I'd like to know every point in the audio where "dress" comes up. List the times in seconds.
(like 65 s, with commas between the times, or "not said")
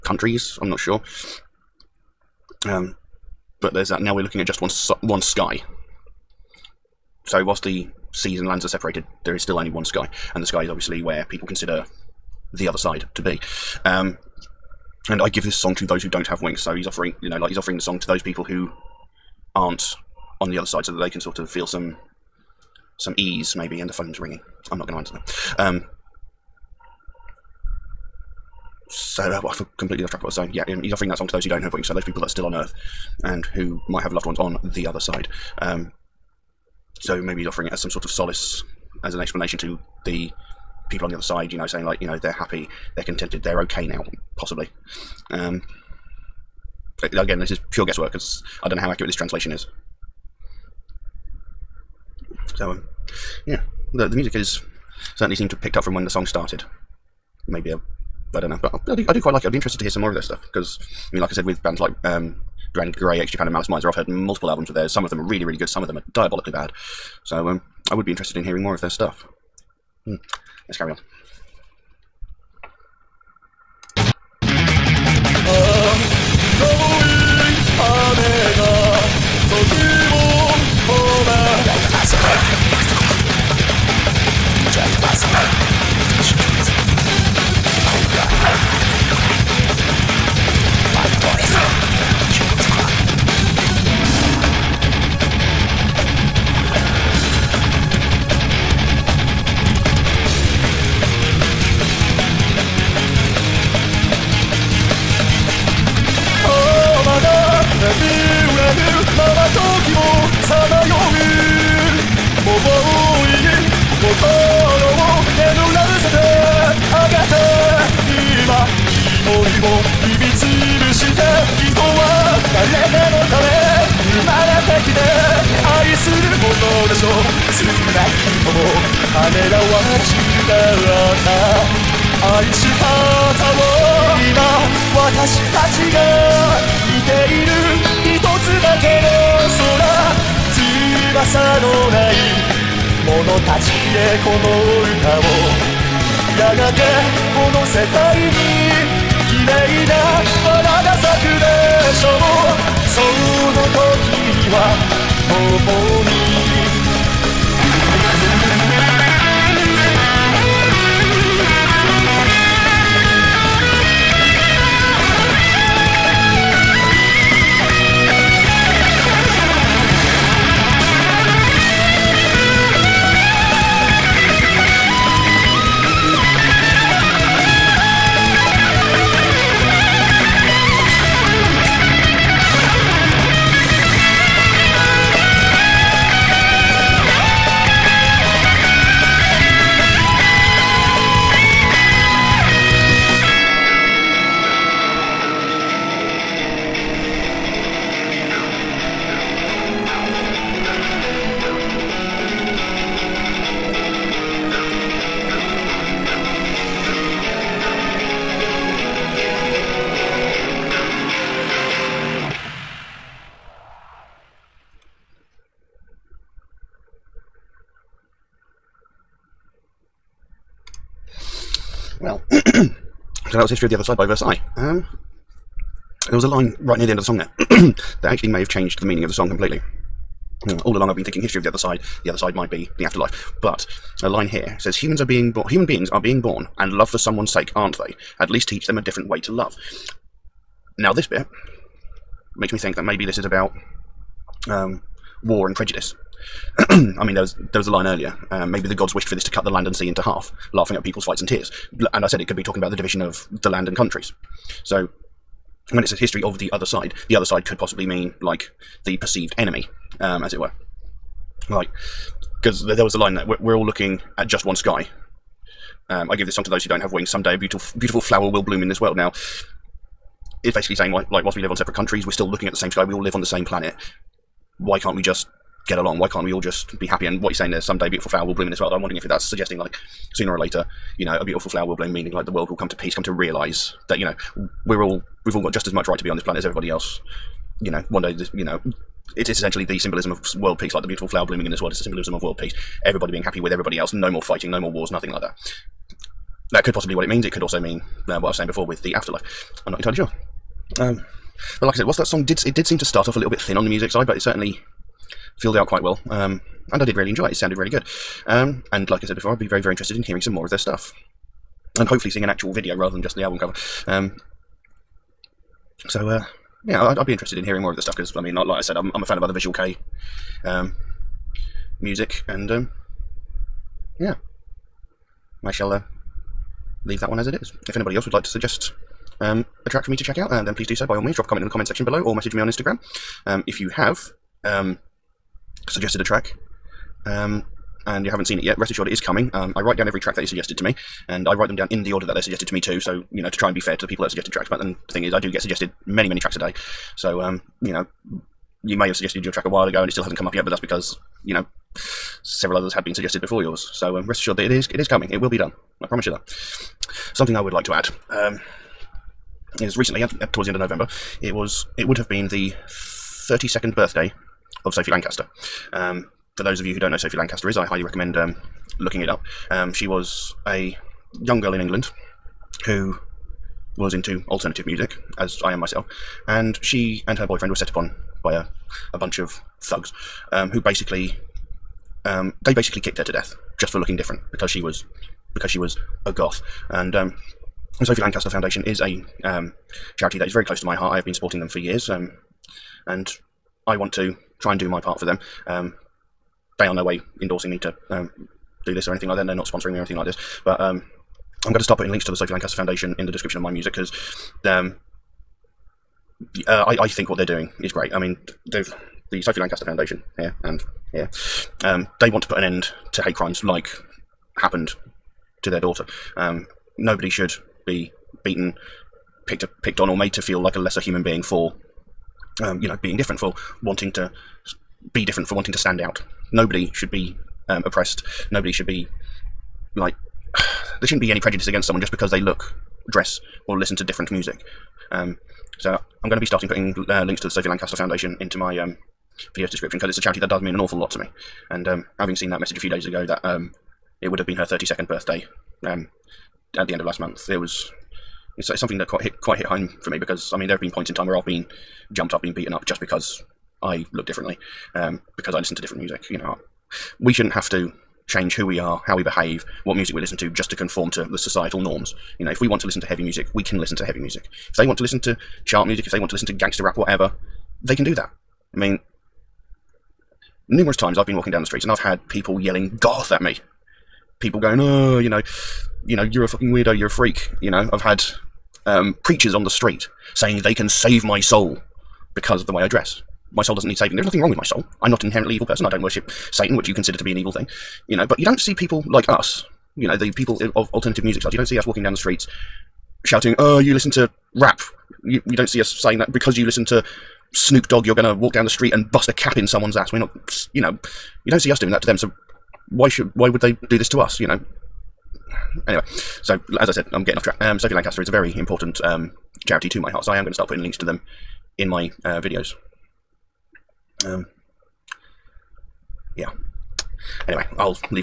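432 s, 482 s.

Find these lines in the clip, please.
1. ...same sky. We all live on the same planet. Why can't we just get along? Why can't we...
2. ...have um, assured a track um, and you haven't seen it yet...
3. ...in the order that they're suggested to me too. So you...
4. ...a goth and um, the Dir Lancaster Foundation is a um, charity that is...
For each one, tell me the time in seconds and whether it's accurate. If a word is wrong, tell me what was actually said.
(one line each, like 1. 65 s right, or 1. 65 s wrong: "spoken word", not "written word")
1. 272 s right
2. 333 s wrong: "suggested", not "assured"
3. 341 s right
4. 386 s wrong: "Sophie", not "Dir".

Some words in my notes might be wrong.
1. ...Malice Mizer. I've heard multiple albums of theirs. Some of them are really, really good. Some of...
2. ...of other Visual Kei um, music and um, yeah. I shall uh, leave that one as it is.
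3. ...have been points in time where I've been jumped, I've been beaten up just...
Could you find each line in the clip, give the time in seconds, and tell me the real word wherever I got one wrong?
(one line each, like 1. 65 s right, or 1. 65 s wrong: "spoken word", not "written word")
1. 63 s right
2. 319 s right
3. 450 s right.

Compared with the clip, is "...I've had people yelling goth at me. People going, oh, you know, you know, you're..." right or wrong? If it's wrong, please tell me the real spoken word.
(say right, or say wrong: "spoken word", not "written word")
right.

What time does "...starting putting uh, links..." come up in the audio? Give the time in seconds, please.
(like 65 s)
436 s.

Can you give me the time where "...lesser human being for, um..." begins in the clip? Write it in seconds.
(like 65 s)
420 s.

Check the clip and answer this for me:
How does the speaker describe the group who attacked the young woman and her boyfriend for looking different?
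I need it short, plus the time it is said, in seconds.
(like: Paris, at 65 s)
a bunch of thugs, at 378 s.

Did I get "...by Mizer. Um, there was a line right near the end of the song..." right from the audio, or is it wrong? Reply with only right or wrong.
wrong.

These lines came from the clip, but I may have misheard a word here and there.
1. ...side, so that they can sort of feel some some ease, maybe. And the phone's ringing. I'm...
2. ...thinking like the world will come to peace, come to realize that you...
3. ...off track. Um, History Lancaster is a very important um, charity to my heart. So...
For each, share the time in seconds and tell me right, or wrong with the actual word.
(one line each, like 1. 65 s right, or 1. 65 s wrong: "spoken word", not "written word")
1. 20 s right
2. 281 s wrong: "meaning", not "thinking"
3. 507 s wrong: "Sophie", not "History".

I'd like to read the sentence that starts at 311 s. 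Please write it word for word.
And hopefully seeing an actual video rather than just the album cover.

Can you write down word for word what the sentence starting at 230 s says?
Hmm, all along, I've been thinking history of the other side.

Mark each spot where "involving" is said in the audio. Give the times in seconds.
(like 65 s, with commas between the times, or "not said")
not said.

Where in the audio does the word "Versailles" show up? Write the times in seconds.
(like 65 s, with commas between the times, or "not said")
224 s.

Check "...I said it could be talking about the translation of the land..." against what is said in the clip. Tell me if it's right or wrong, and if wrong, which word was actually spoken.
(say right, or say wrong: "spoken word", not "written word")
wrong: "division", not "translation".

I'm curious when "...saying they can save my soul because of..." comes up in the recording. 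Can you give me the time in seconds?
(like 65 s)
480 s.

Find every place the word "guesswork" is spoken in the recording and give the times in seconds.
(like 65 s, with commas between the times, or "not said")
47 s.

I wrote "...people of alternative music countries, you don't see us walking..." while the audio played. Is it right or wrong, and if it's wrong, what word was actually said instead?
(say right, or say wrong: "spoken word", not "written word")
wrong: "styles", not "countries".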